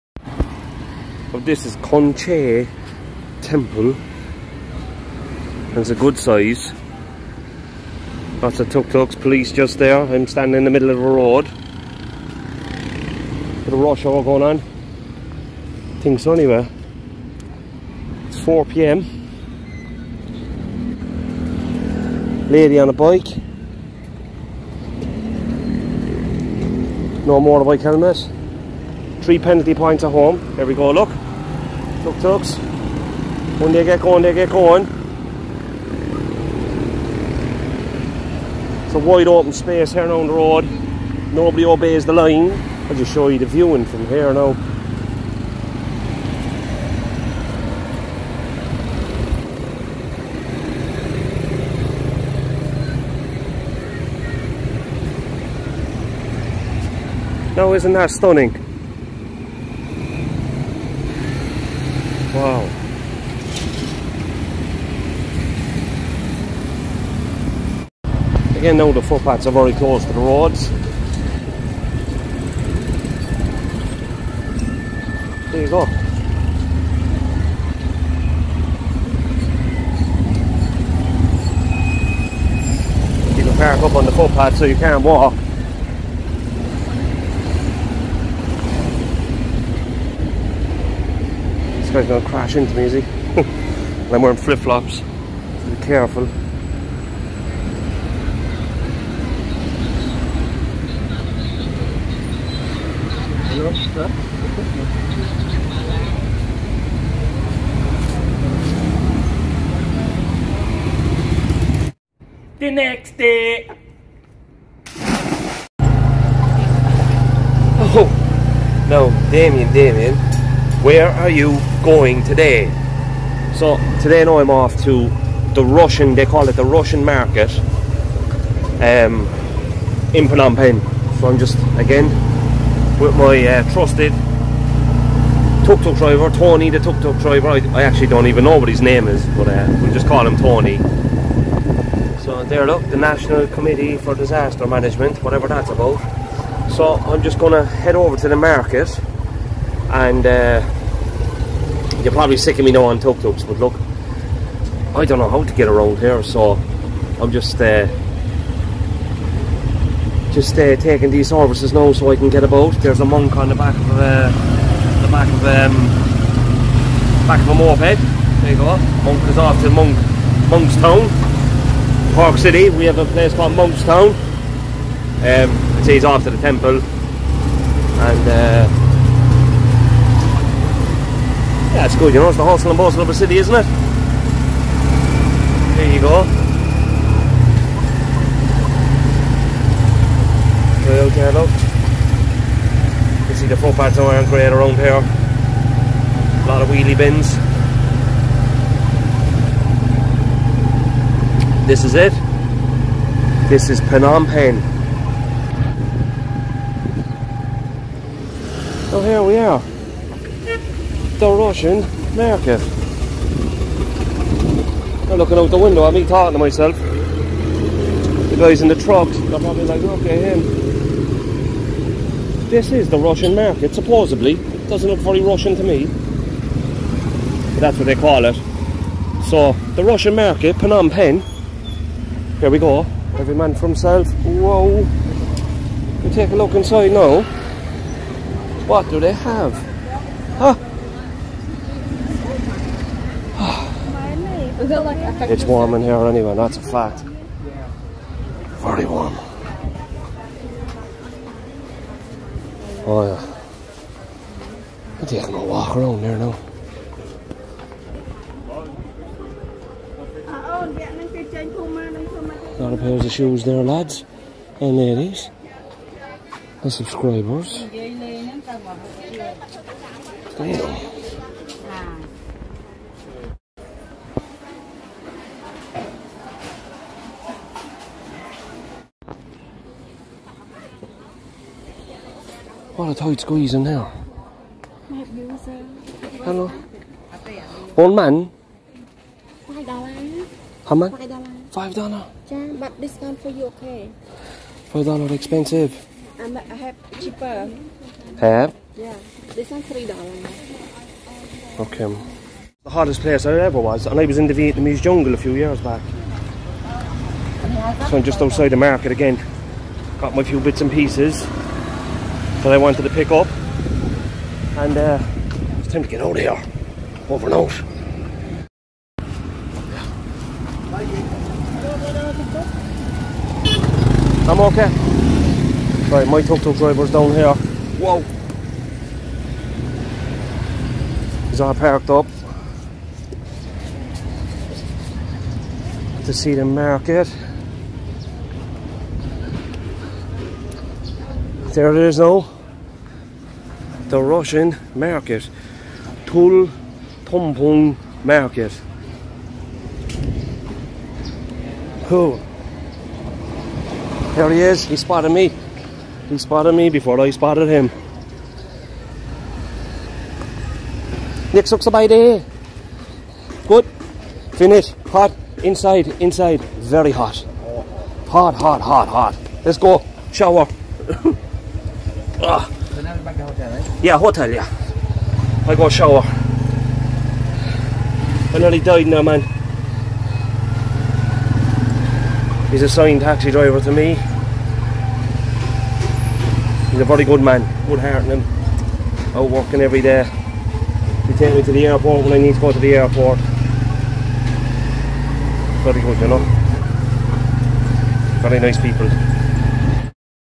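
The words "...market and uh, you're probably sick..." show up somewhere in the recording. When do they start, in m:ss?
2:28.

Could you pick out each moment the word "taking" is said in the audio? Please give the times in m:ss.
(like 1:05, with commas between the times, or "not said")
2:40, 4:15.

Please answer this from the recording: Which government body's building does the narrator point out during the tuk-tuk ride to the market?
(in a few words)
National Committee for Disaster Management.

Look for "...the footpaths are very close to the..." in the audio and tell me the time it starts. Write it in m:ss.
1:08.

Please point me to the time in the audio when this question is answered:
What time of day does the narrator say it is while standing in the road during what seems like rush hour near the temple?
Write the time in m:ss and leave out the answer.
0:18.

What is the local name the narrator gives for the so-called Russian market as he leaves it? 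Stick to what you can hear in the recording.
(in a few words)
Toul Tompoung Market.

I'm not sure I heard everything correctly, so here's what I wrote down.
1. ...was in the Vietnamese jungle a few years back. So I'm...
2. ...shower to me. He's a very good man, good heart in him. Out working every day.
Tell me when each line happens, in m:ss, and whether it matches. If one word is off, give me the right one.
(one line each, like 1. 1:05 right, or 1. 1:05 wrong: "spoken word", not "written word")
1. 5:04 right
2. 6:23 wrong: "driver", not "shower".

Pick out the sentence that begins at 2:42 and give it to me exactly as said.
There's a monk on the back of uh, the back of um, back of a moped.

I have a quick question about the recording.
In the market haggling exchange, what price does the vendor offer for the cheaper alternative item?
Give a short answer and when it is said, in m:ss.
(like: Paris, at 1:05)
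$3, at 4:59.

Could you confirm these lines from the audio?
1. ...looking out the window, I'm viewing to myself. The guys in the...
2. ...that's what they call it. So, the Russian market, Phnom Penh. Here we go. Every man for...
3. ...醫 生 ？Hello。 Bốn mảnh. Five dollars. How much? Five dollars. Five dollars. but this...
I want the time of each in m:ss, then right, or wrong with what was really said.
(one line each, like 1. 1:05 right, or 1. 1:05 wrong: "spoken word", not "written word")
1. 3:35 wrong: "talking", not "viewing"
2. 3:47 right
3. 4:45 right.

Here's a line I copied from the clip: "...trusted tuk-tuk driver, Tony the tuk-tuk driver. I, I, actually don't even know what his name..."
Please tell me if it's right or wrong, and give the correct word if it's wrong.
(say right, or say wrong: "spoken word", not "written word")
right.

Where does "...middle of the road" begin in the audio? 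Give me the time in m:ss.
0:10.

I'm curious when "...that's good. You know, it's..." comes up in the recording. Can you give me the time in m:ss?
3:01.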